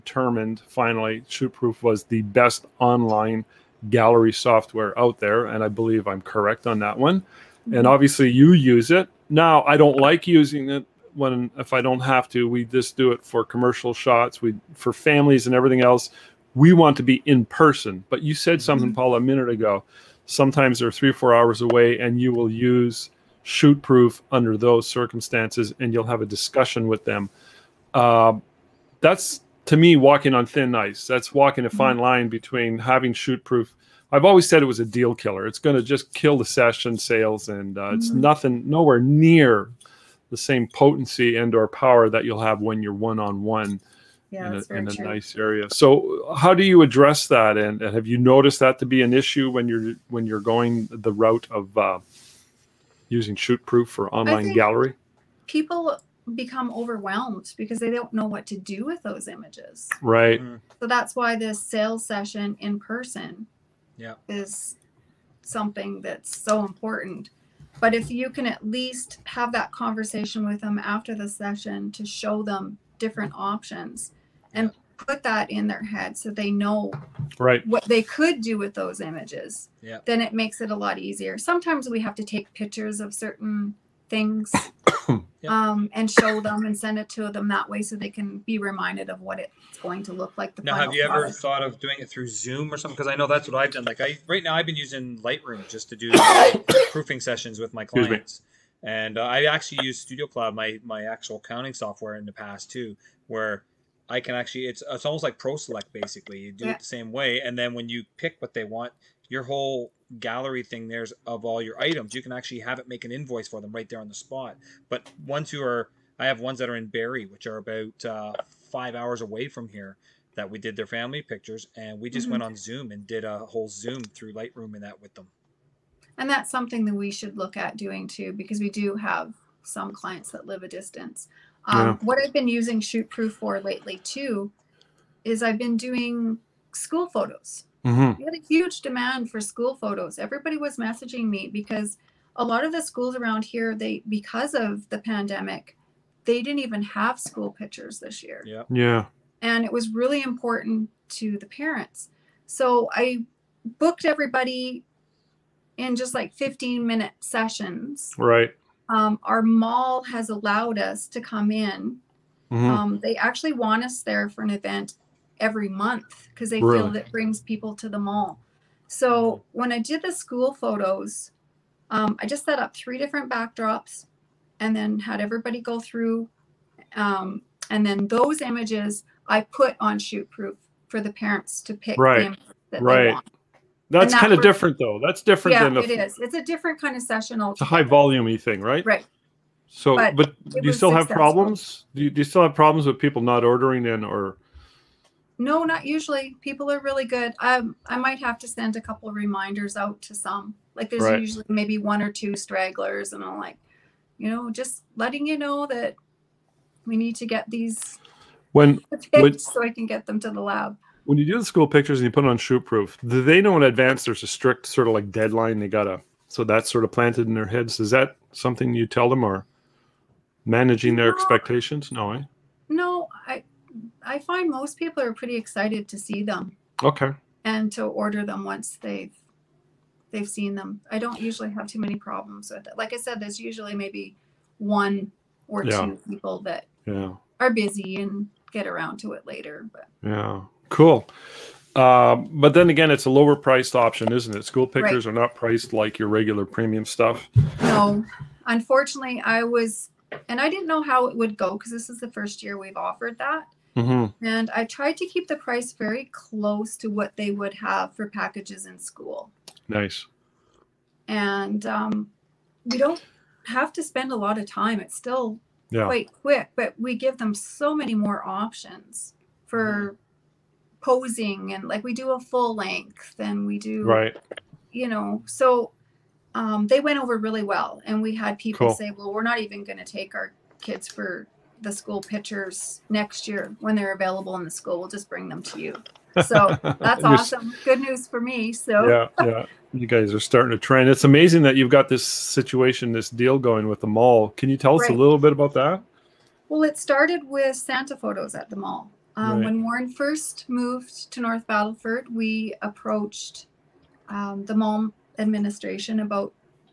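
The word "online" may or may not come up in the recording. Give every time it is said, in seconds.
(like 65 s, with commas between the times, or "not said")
2 s, 54 s.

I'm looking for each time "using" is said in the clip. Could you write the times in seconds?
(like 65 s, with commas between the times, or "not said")
10 s, 53 s, 94 s, 132 s.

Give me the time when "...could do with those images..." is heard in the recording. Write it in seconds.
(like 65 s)
78 s.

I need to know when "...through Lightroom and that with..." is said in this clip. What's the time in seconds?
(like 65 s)
124 s.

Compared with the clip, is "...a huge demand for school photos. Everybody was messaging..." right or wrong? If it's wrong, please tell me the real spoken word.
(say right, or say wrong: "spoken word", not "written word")
right.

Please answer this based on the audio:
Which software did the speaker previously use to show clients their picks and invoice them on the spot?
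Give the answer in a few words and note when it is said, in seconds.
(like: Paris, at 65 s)
Studio Cloud, at 100 s.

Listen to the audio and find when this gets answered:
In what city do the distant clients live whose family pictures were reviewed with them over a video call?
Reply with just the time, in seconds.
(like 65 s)
116 s.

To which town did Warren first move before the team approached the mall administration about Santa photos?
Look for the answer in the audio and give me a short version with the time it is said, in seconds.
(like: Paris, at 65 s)
North Battleford, at 301 s.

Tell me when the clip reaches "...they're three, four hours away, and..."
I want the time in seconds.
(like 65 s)
20 s.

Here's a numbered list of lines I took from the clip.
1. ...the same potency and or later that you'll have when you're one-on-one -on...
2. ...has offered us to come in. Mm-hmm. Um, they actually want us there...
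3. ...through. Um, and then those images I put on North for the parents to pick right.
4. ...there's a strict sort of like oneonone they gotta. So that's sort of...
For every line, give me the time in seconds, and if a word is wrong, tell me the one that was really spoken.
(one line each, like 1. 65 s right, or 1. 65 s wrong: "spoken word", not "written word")
1. 40 s wrong: "power", not "later"
2. 160 s wrong: "allowed", not "offered"
3. 175 s wrong: "ShootProof", not "North"
4. 214 s wrong: "deadline", not "oneonone".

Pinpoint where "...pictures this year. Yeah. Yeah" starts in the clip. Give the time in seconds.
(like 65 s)
147 s.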